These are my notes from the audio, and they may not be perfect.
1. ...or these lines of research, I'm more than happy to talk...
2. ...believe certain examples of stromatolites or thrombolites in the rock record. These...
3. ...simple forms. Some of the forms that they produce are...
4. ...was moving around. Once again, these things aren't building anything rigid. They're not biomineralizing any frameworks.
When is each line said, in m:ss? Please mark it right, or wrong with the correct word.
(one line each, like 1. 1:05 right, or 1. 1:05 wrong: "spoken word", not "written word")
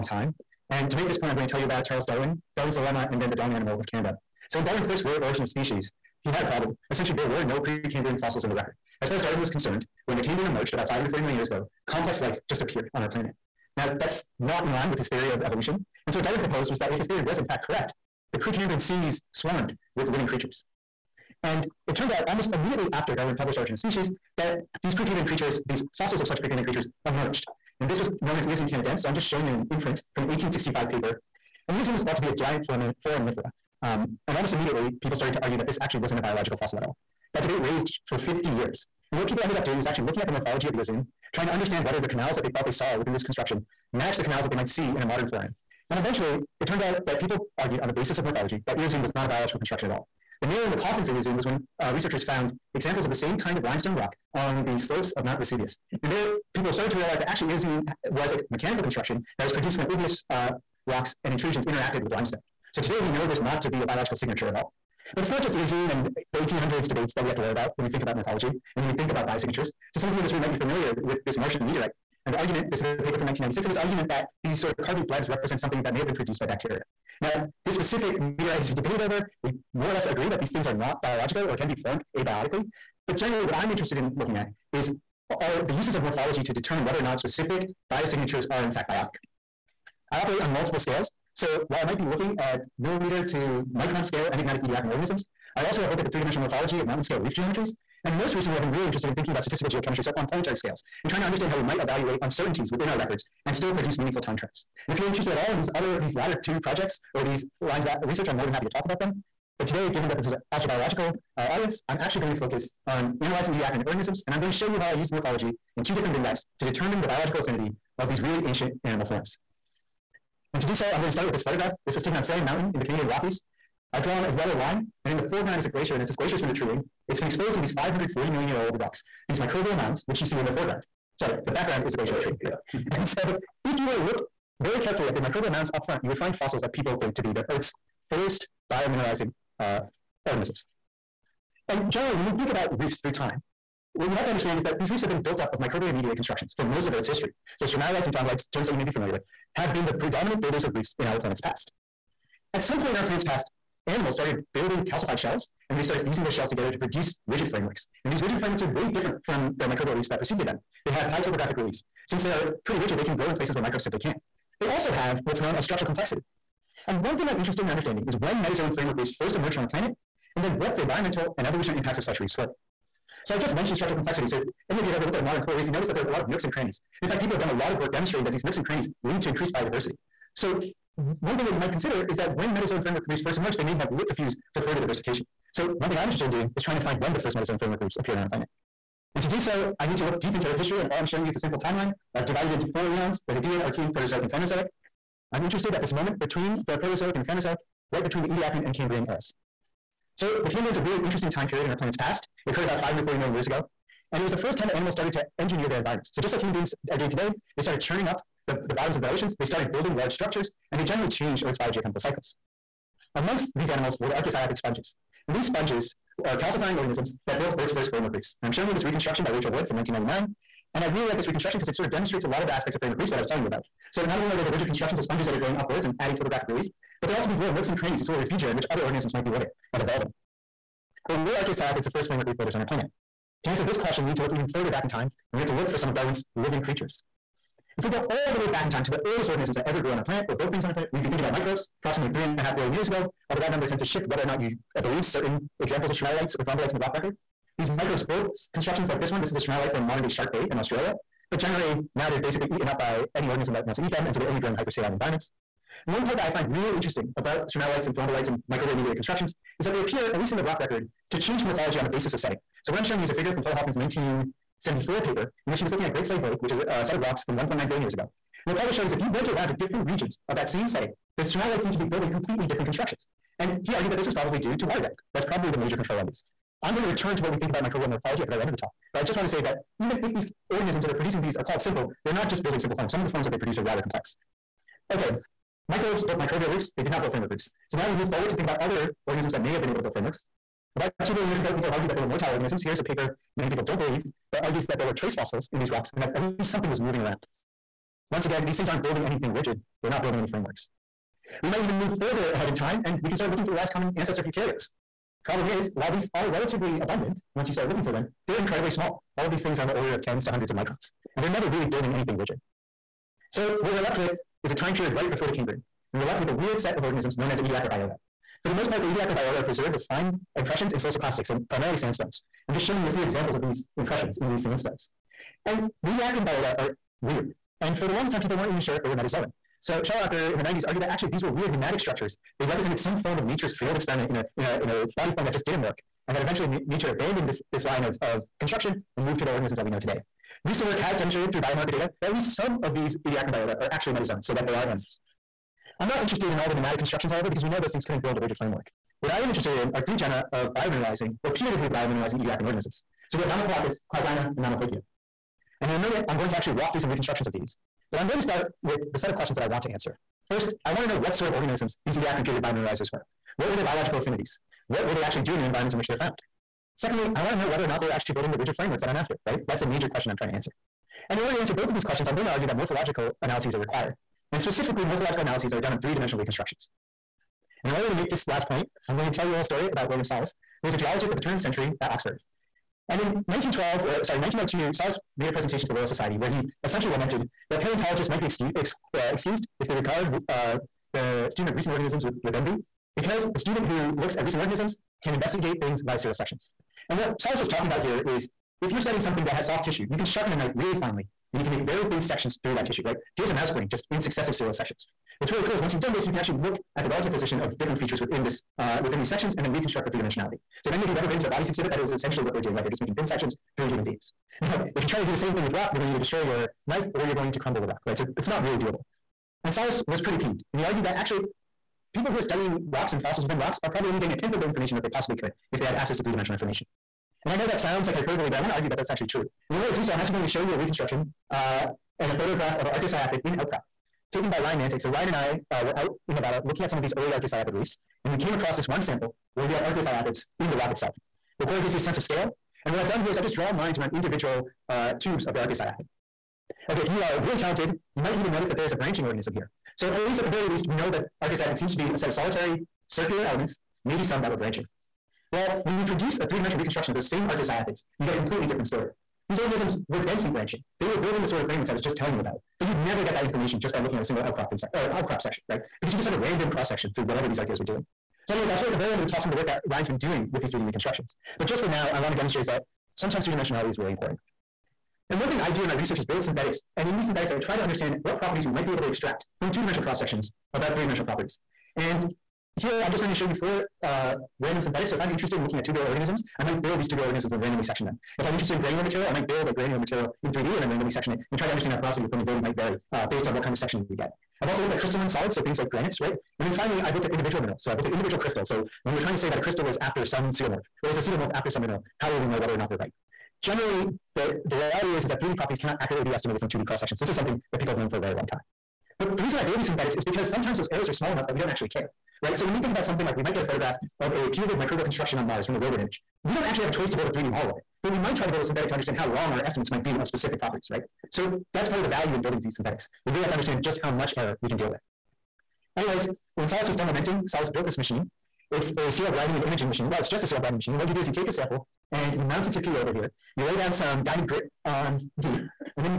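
1. 1:47 right
2. 4:04 right
3. 4:42 right
4. 4:56 wrong: "building", not "biomineralizing".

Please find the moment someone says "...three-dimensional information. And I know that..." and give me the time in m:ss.
7:06.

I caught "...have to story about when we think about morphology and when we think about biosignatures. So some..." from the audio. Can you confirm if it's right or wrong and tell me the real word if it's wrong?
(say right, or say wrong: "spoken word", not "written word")
wrong: "worry", not "story".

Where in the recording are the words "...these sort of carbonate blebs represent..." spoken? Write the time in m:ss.
1:14.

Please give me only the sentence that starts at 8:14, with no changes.
I've also looked at crystalline solids, so things like granites, right?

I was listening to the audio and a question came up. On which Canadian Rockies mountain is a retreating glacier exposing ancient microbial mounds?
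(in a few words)
Salient Mountain.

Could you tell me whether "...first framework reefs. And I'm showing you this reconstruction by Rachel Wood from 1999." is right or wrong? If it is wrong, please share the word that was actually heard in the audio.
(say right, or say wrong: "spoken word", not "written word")
right.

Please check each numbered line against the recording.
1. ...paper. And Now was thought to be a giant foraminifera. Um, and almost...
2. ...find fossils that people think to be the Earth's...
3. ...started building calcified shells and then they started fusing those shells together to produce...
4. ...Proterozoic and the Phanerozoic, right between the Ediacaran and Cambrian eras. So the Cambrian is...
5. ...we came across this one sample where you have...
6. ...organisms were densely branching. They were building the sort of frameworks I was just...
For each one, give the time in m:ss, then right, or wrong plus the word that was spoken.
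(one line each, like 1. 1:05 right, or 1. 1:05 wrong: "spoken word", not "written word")
1. 0:30 wrong: "Eozoon", not "Now"
2. 2:16 right
3. 2:34 right
4. 3:16 right
5. 7:18 right
6. 7:39 right.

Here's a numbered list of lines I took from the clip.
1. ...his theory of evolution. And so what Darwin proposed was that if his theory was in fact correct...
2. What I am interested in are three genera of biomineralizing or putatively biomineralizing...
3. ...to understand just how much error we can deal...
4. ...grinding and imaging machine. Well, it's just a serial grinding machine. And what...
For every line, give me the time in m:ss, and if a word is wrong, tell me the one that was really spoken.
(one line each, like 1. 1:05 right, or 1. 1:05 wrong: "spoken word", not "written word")
1. 0:14 right
2. 5:49 right
3. 8:43 right
4. 8:49 right.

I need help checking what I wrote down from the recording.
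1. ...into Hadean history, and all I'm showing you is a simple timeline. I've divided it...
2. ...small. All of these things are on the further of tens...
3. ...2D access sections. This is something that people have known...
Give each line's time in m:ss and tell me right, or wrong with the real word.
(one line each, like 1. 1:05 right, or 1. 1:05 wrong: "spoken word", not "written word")
1. 3:10 wrong: "Earth", not "Hadean"
2. 5:08 wrong: "order", not "further"
3. 8:26 wrong: "cross", not "access".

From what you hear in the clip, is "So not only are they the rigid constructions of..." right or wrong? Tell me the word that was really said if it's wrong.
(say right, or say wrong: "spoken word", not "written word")
right.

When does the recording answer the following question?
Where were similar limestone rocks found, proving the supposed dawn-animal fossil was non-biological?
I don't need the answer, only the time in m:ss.
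0:55.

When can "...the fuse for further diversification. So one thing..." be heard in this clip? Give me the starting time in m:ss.
3:04.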